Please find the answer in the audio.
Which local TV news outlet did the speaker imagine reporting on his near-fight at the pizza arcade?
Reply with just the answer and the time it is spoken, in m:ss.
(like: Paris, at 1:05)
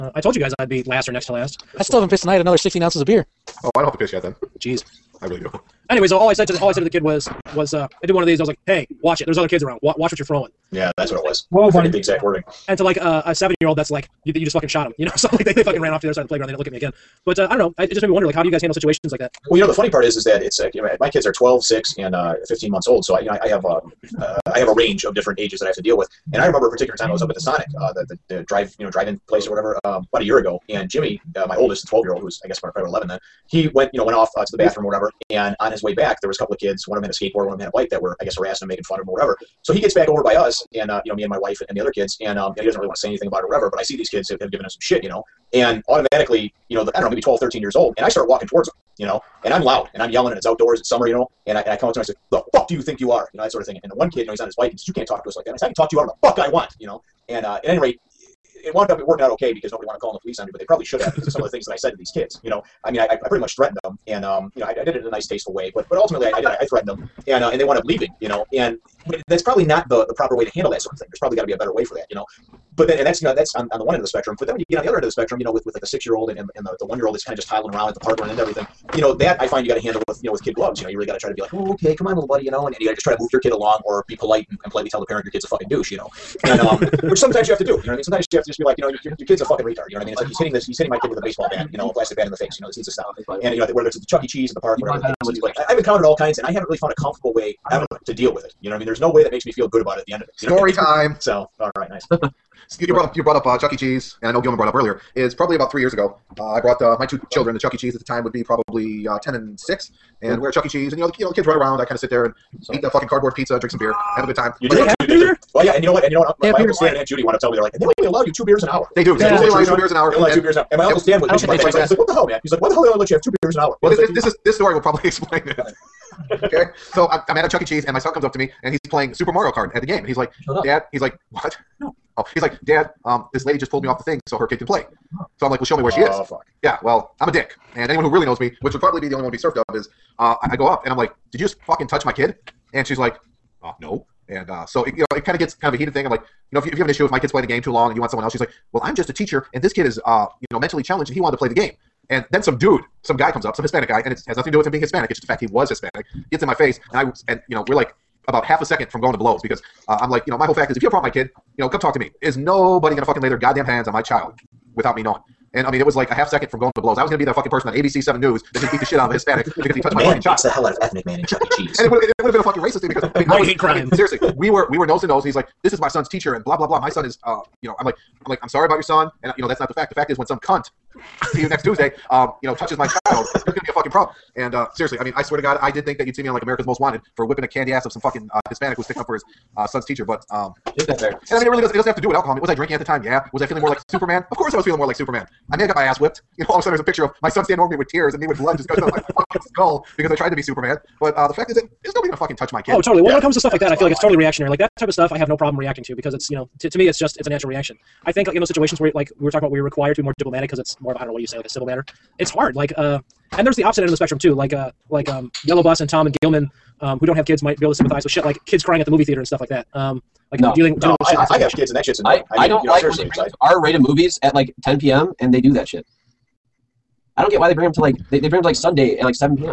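ABC 7 News, at 2:47.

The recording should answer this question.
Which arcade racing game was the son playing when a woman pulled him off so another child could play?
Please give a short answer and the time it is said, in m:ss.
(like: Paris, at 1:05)
Super Mario Kart, at 2:09.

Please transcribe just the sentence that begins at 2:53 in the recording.
I mean, seriously, we were we were nose to nose, and he's like, "This is my son's teacher," and blah blah blah.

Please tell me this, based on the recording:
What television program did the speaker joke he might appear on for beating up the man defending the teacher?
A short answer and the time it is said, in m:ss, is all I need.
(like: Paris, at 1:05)
America's Most Wanted, at 3:06.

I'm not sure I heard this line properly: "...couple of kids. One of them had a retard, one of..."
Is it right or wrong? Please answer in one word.
wrong.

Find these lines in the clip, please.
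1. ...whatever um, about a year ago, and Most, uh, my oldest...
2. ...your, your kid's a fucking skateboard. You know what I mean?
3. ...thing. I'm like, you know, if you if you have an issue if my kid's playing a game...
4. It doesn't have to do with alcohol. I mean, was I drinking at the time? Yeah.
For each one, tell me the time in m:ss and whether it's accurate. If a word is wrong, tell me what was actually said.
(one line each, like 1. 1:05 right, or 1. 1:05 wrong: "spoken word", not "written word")
1. 0:29 wrong: "Jimmy", not "Most"
2. 1:29 wrong: "retard", not "skateboard"
3. 2:25 right
4. 3:11 right.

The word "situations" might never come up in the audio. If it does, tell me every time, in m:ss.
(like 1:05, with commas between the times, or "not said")
0:18, 3:28.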